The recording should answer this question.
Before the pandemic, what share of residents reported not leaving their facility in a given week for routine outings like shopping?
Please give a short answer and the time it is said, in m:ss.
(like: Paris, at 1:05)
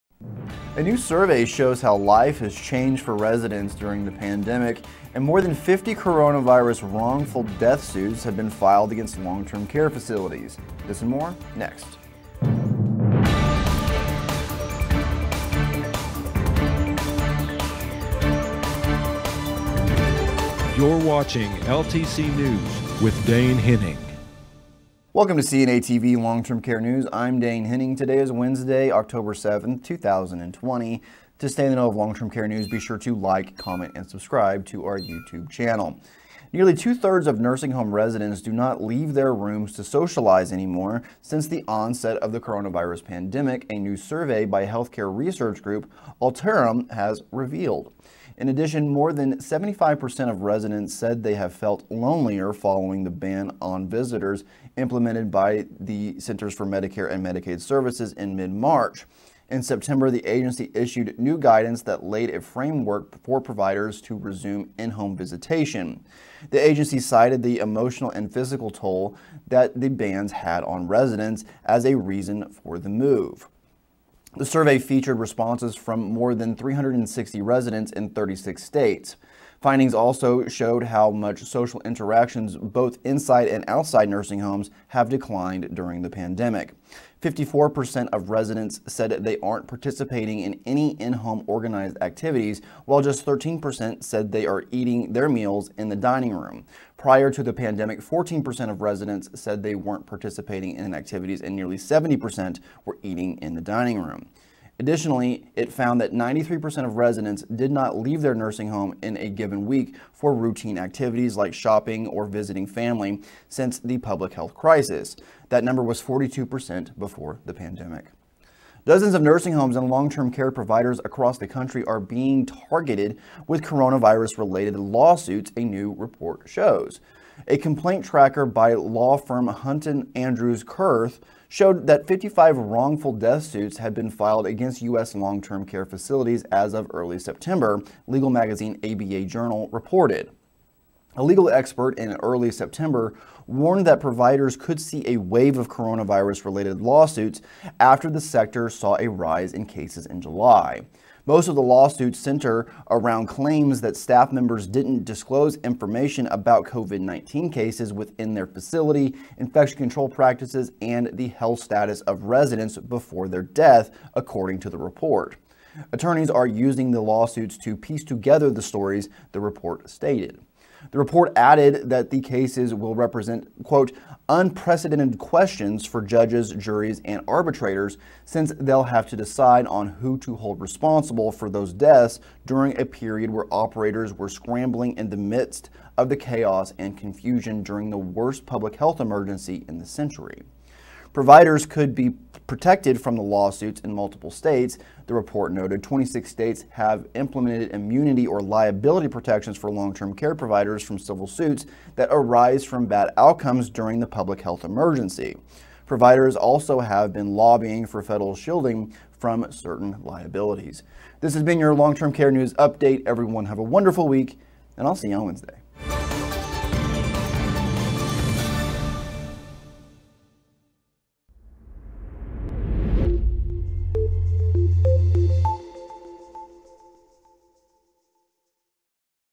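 42%, at 1:56.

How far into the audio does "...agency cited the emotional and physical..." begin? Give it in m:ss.
1:06.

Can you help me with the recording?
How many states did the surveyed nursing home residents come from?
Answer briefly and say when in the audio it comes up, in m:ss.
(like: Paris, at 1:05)
36, at 1:18.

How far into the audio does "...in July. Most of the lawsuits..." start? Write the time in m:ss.
2:30.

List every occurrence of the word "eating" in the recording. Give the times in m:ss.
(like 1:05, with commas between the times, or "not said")
1:34, 1:43.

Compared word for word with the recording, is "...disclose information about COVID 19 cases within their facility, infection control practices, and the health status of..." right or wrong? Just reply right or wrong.
right.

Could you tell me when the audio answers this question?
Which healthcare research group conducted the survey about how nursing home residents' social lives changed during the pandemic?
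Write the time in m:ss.
0:46.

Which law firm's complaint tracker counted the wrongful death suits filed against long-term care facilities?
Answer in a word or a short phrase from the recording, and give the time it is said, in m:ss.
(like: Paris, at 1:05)
Hunton Andrews Kurth, at 2:09.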